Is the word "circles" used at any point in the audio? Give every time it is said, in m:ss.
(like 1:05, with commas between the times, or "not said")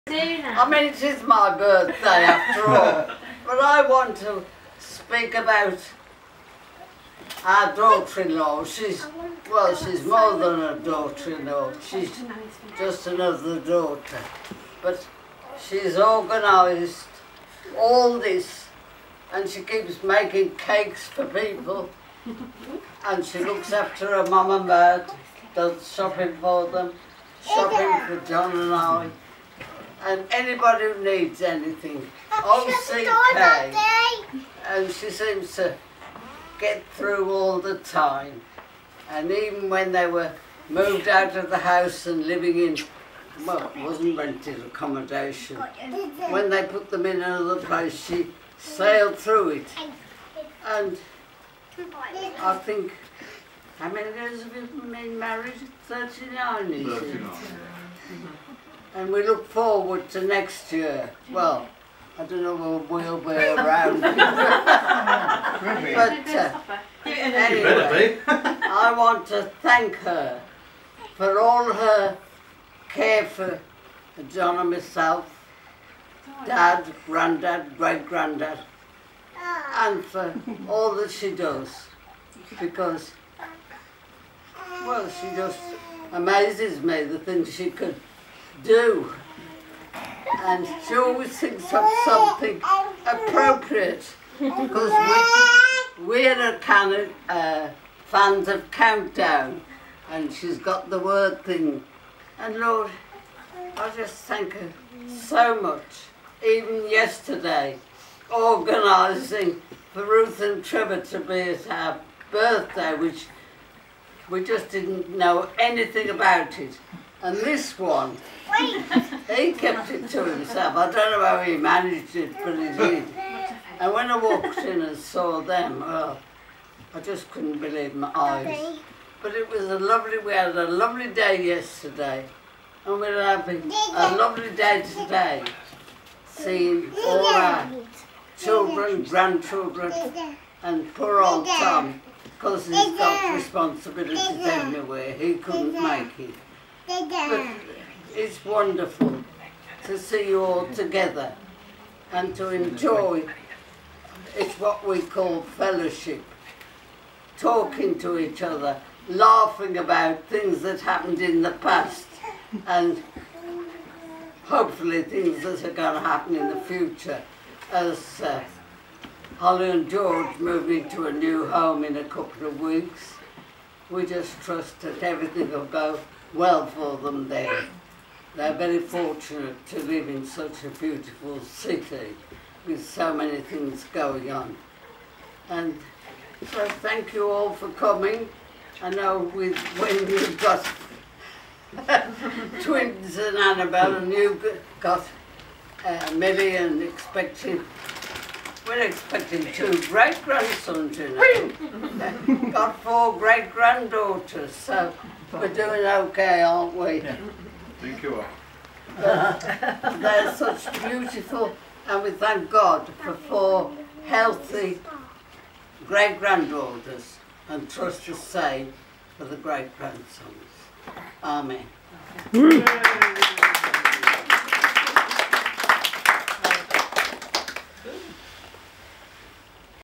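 not said.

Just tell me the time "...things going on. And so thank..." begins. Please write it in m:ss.
3:03.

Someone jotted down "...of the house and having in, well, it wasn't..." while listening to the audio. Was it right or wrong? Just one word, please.
wrong.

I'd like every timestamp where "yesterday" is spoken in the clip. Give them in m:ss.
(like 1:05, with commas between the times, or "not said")
1:46, 2:11.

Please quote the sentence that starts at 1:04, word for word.
but uh, anyway, I want to thank her for all her care for John and myself, Dad, Granddad, Great Granddad, ah.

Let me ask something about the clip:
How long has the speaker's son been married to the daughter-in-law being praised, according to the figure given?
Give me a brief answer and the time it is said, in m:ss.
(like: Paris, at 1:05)
39 years, at 0:55.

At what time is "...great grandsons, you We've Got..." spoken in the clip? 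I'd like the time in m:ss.
3:19.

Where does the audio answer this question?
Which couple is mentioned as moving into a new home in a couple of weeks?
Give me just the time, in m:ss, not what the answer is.
2:49.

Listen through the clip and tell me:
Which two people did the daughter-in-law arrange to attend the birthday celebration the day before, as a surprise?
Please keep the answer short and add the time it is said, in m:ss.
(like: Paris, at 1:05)
Ruth and Trevor, at 1:50.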